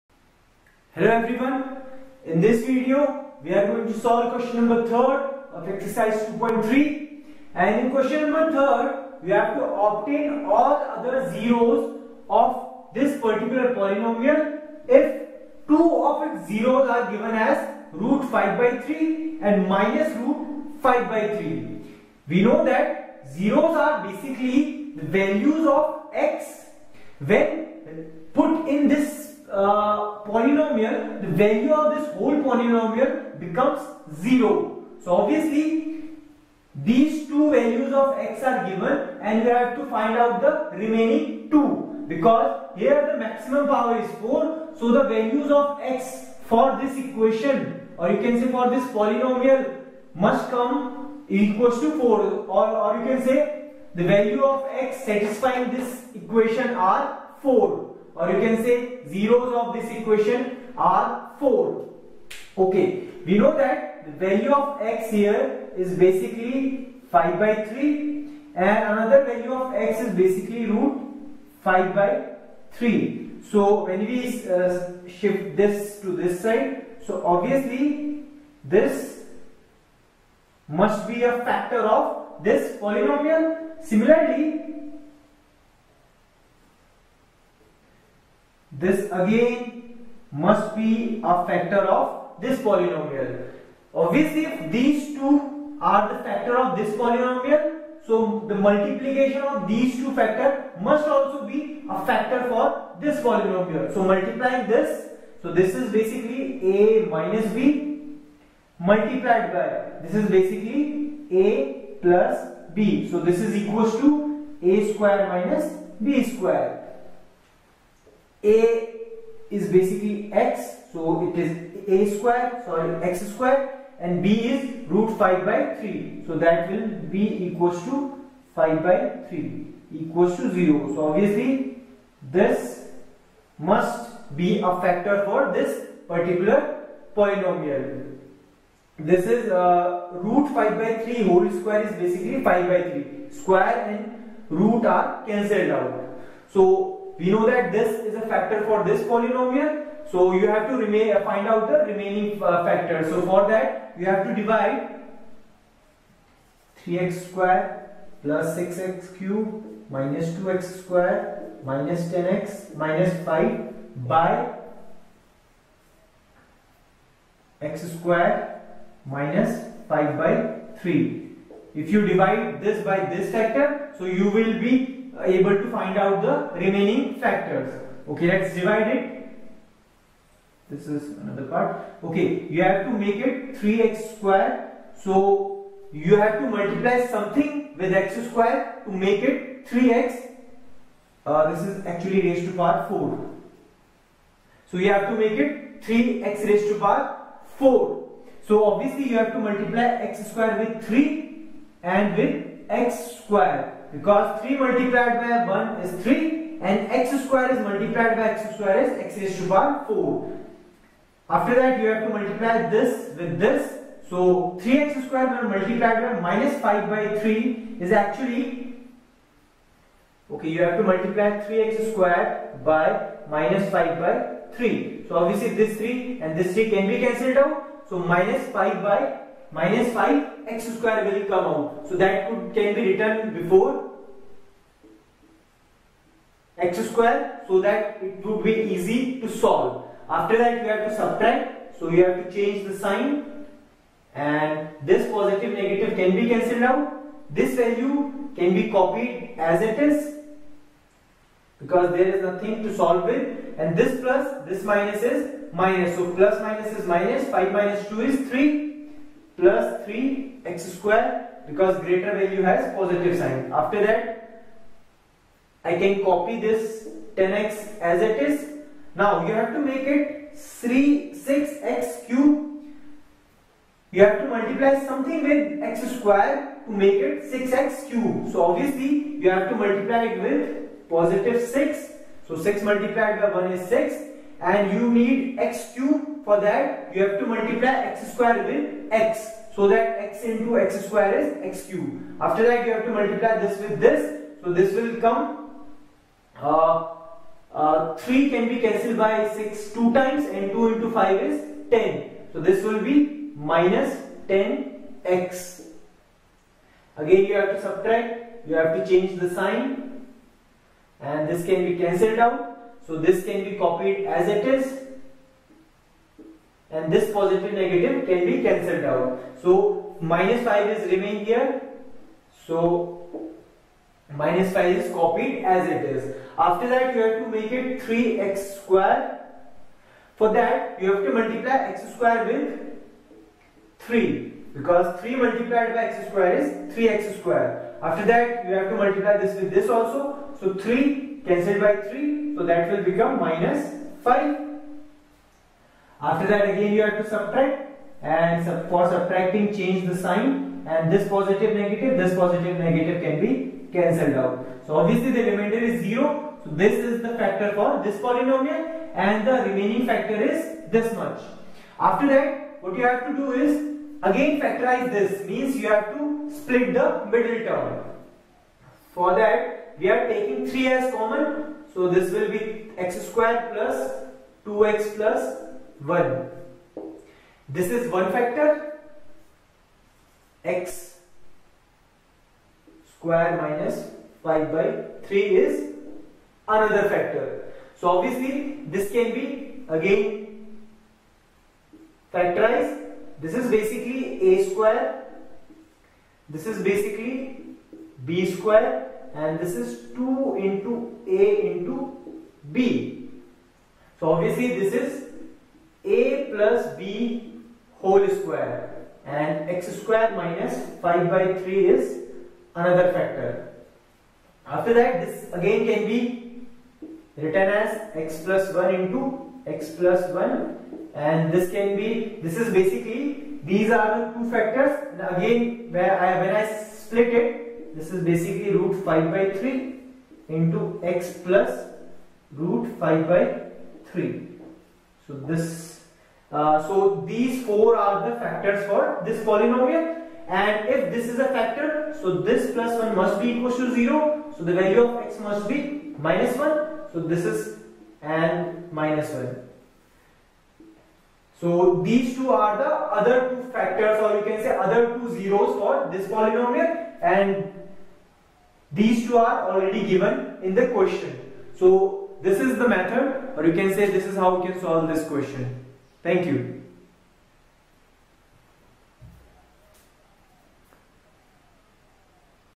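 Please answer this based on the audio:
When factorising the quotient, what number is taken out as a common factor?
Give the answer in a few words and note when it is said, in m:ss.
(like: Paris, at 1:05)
3, at 6:10.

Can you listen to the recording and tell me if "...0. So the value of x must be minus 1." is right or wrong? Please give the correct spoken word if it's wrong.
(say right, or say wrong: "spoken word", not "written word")
right.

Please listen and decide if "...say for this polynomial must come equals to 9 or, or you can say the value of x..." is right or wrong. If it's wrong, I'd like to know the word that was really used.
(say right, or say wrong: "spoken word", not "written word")
wrong: "4", not "9".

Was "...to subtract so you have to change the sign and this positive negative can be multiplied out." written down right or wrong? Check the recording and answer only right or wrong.
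wrong.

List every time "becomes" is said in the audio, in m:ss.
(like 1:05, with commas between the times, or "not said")
0:33, 5:42.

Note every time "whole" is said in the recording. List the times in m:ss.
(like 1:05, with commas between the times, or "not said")
0:32, 2:21, 6:47.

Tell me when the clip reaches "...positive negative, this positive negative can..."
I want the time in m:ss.
5:51.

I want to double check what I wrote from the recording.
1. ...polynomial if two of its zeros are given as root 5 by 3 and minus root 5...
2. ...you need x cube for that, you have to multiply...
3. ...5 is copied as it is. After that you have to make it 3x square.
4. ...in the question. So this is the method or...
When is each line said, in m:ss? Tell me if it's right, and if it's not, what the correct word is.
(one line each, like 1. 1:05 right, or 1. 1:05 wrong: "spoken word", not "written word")
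1. 0:13 right
2. 4:44 right
3. 5:24 right
4. 7:40 right.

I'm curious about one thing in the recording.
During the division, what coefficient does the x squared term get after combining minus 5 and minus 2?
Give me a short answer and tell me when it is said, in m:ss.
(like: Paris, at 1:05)
3, at 4:19.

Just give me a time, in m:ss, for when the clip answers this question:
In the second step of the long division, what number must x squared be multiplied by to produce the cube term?
4:40.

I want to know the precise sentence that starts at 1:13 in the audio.
So when we uh, shift this to this side, so obviously this must be a factor of this polynomial.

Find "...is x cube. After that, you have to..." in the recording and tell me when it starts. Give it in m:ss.
4:51.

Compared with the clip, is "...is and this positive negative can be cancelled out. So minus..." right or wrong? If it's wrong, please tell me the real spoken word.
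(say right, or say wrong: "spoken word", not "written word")
right.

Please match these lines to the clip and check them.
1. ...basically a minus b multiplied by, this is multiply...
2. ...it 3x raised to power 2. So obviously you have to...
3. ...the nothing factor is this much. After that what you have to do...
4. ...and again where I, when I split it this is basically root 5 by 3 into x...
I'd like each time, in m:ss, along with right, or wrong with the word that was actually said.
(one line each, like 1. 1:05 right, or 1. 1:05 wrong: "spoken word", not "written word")
1. 1:45 wrong: "basically", not "multiply"
2. 3:15 wrong: "4", not "2"
3. 5:59 wrong: "remaining", not "nothing"
4. 7:04 right.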